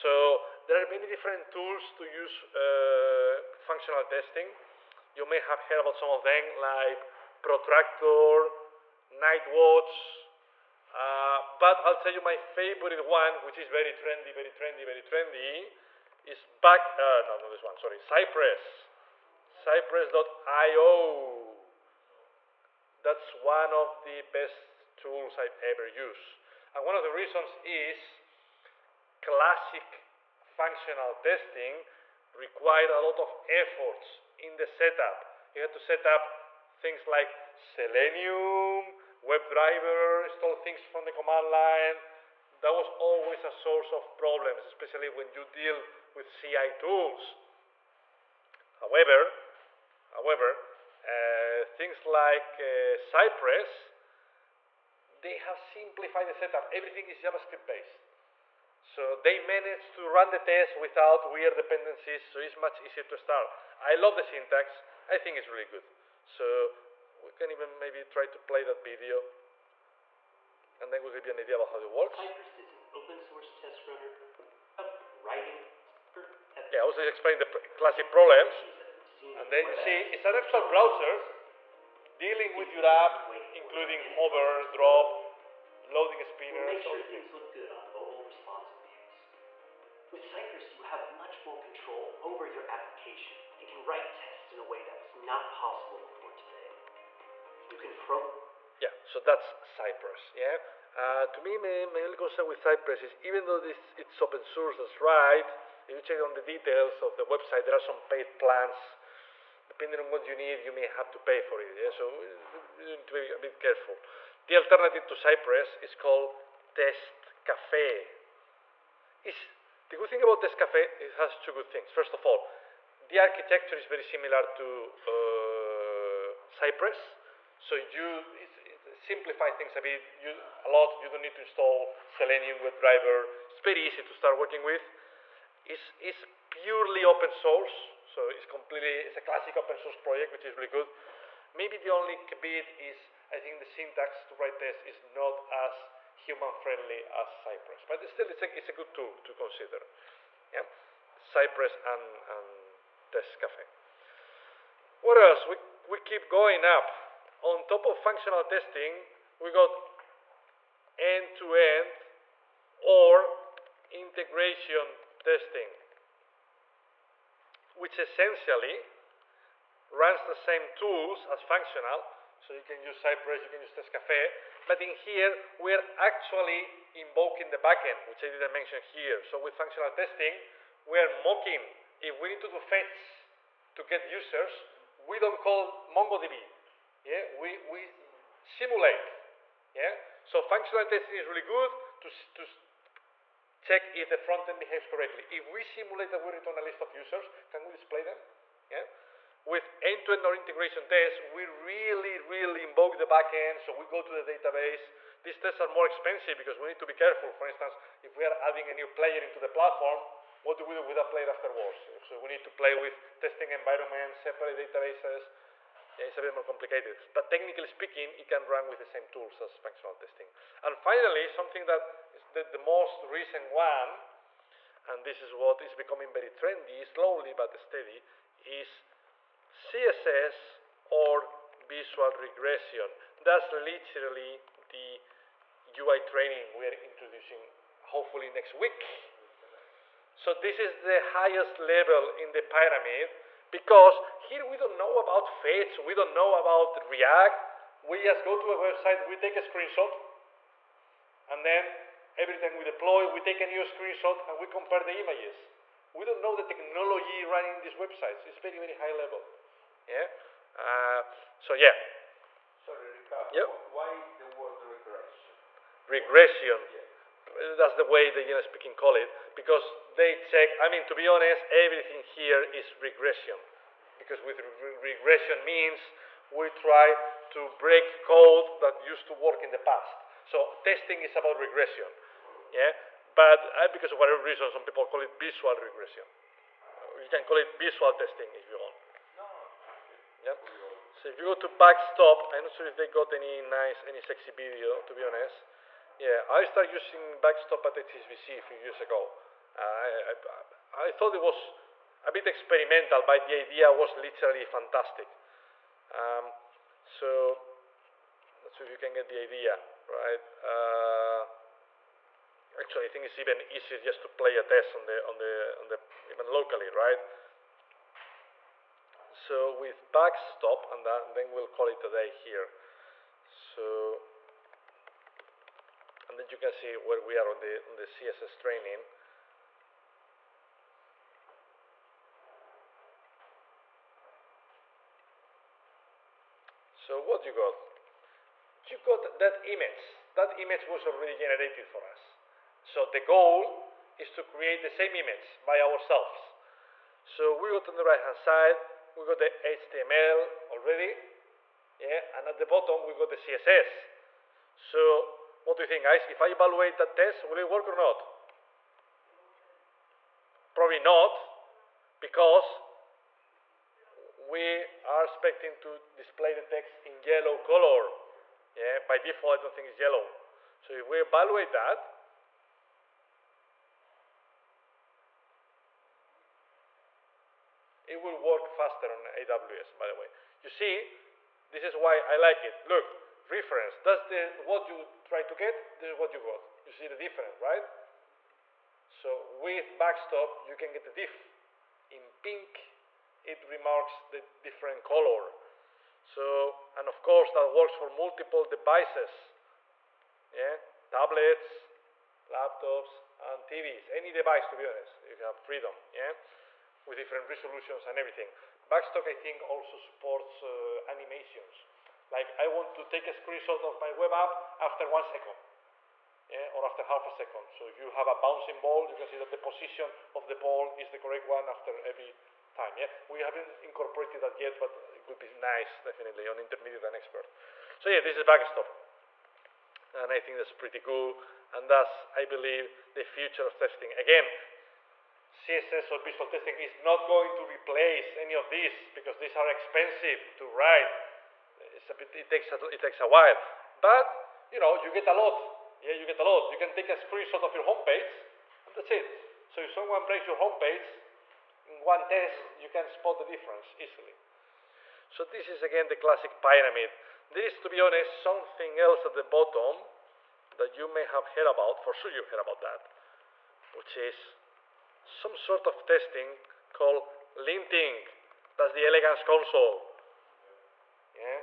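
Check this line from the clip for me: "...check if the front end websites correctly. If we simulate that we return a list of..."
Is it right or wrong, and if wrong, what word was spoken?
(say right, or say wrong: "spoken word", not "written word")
wrong: "behaves", not "websites".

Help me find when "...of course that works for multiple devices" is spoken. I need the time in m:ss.
6:36.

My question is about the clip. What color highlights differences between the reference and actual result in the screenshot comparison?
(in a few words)
pink.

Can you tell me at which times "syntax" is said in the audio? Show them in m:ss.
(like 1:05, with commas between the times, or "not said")
1:04, 2:23.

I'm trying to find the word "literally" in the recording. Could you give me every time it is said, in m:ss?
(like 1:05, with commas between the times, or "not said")
3:53, 5:03.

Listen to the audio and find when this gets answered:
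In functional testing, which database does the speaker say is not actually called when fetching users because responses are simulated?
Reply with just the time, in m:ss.
3:05.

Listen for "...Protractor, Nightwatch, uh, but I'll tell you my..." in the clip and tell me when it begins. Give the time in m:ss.
0:07.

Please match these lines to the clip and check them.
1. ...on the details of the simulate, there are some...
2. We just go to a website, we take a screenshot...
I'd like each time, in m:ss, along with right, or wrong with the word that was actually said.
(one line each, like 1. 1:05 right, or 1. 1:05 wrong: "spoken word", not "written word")
1. 1:46 wrong: "website", not "simulate"
2. 4:07 right.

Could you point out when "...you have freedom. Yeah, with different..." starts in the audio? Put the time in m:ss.
6:45.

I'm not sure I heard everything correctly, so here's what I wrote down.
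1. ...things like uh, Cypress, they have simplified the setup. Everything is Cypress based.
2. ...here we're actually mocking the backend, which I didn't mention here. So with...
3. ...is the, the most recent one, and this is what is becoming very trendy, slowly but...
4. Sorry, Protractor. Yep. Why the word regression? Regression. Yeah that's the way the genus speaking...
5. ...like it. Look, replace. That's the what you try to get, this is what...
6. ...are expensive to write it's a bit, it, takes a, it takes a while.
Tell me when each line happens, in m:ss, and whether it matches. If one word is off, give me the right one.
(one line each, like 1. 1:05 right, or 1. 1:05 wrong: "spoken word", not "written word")
1. 0:51 wrong: "JavaScript", not "Cypress"
2. 2:54 wrong: "invoking", not "mocking"
3. 3:42 right
4. 4:22 wrong: "Ricardo", not "Protractor"
5. 6:22 wrong: "reference", not "replace"
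6. 7:19 right.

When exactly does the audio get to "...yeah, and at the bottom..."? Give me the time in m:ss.
5:51.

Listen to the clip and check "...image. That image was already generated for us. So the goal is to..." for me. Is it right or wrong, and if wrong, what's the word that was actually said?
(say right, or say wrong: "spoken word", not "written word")
right.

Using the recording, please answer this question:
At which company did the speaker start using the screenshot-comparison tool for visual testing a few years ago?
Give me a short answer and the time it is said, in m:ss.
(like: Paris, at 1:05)
HSBC, at 4:57.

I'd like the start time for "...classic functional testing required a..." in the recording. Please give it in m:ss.
0:29.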